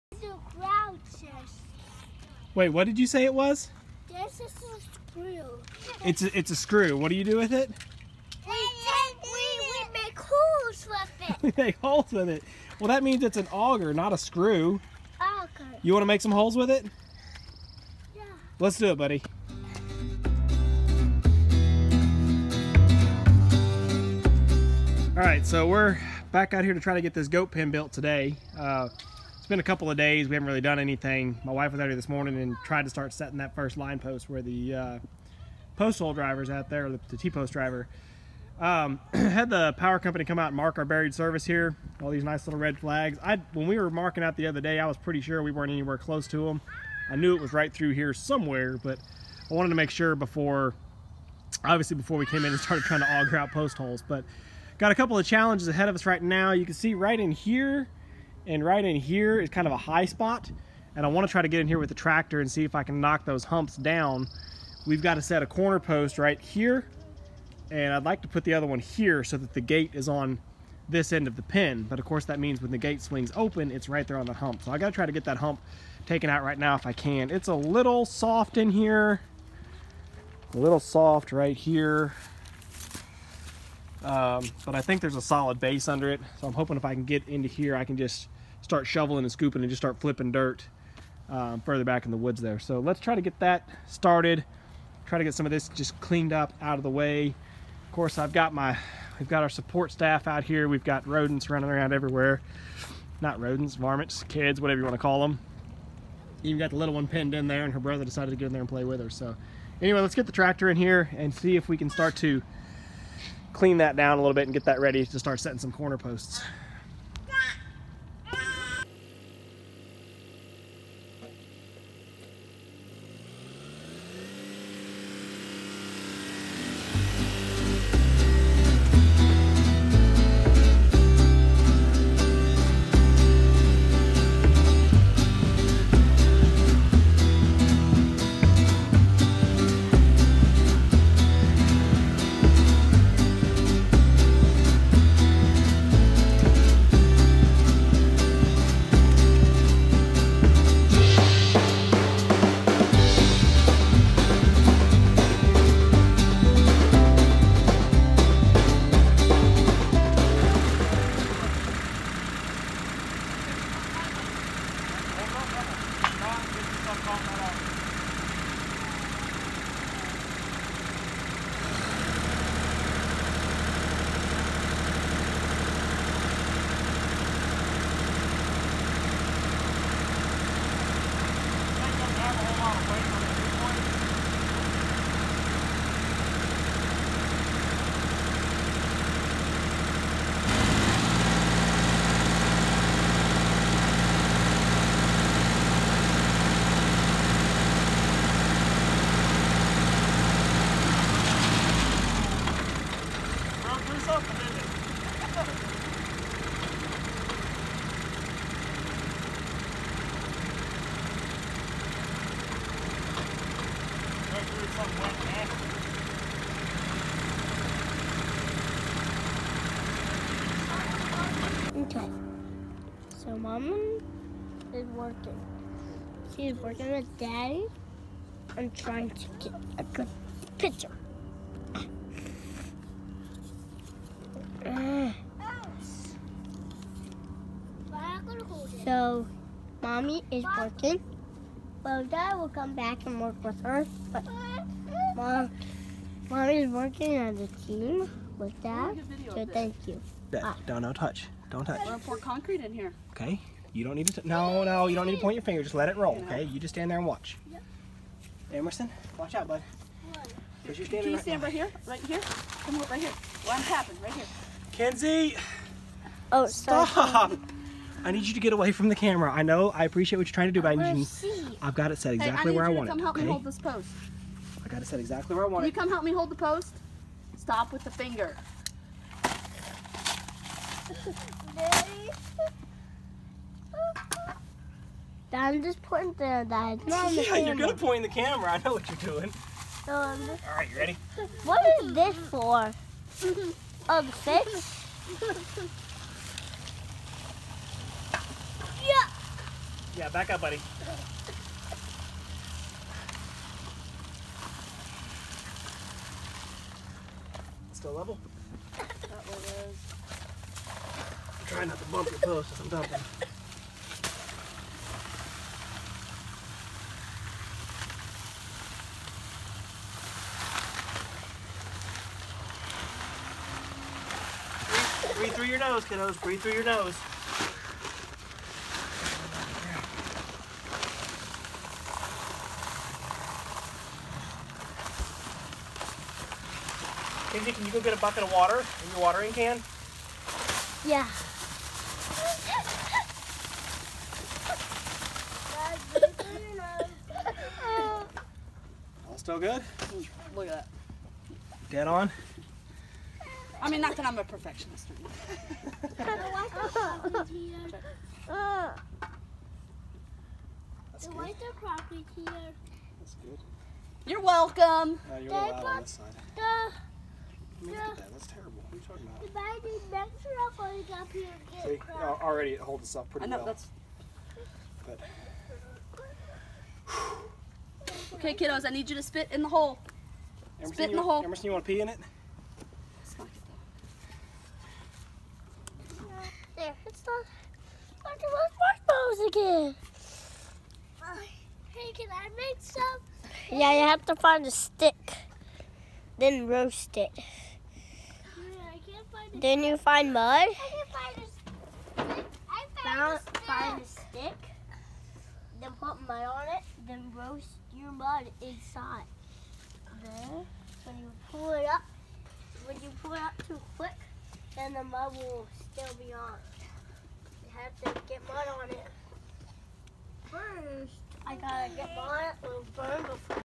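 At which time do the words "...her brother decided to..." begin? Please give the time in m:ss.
1:47.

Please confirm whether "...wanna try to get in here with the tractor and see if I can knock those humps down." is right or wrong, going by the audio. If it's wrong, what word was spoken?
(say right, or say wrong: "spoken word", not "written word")
right.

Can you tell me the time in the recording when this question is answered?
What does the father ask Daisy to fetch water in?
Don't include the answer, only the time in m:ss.
5:39.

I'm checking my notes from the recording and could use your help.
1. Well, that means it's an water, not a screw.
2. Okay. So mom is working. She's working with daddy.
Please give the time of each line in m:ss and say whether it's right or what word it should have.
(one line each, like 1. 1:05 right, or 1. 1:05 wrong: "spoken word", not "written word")
1. 0:12 wrong: "auger", not "water"
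2. 3:41 right.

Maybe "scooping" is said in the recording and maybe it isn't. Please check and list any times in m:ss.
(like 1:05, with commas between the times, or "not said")
1:29.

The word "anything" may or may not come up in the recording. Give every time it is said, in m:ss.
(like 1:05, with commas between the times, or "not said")
0:30.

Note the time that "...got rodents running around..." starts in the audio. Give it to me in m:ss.
1:40.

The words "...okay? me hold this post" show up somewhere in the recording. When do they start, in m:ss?
4:33.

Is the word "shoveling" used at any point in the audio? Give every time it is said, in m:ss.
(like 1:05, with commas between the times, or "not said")
1:28.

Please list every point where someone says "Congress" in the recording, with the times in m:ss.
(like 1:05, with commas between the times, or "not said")
not said.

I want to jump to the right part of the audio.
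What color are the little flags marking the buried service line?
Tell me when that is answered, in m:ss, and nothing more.
0:42.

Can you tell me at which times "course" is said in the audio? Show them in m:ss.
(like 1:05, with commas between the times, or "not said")
1:12, 1:37.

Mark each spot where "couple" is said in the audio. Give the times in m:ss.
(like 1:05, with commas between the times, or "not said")
0:29, 0:54.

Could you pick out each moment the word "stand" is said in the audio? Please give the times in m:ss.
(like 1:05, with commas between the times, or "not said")
4:16, 4:21.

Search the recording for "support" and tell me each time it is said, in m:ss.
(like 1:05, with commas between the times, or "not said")
1:39.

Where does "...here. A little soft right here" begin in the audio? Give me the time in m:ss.
1:18.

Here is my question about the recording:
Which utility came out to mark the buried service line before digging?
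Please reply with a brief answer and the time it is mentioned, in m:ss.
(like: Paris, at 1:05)
The power company, at 0:39.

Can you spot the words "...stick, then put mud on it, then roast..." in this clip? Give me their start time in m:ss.
6:43.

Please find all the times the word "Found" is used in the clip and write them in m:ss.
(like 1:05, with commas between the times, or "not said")
6:42.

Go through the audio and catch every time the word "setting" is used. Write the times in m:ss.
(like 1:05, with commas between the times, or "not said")
0:33, 1:55.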